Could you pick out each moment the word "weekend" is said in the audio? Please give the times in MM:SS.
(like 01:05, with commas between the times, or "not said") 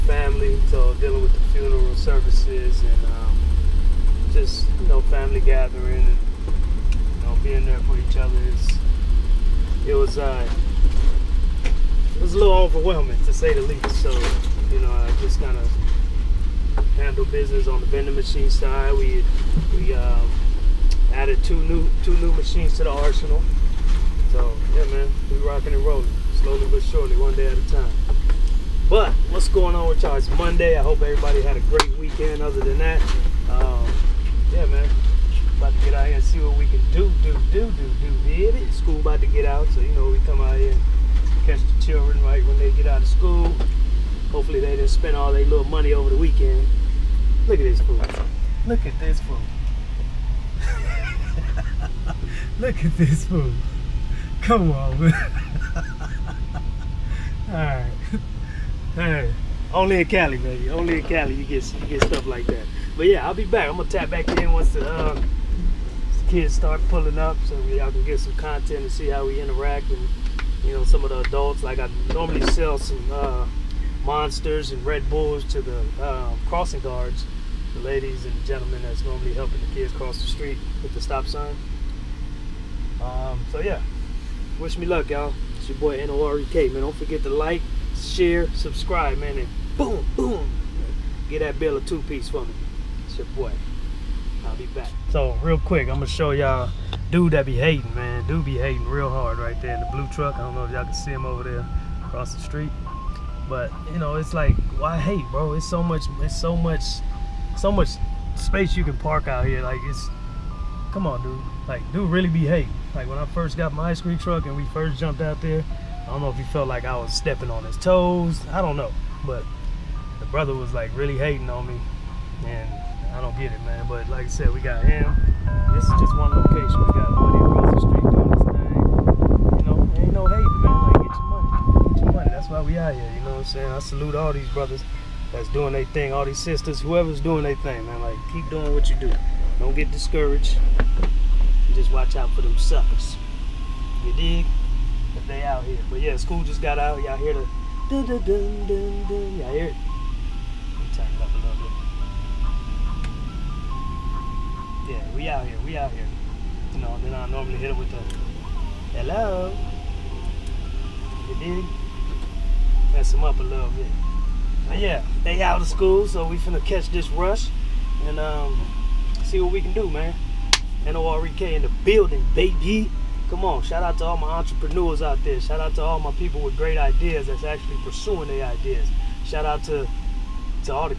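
00:31, 00:46.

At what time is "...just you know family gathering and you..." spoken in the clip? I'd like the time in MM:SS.
00:04.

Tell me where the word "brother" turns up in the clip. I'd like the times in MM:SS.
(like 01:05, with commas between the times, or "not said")
02:00, 02:14.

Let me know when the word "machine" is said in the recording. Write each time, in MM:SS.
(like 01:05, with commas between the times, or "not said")
00:18, 00:22.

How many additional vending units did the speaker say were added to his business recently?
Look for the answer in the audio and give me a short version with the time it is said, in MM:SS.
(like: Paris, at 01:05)
2, at 00:21.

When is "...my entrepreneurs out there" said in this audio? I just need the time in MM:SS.
02:54.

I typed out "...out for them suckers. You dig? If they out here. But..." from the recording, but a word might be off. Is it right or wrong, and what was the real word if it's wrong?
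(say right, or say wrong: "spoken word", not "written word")
right.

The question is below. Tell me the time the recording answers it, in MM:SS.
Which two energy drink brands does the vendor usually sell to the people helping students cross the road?
01:14.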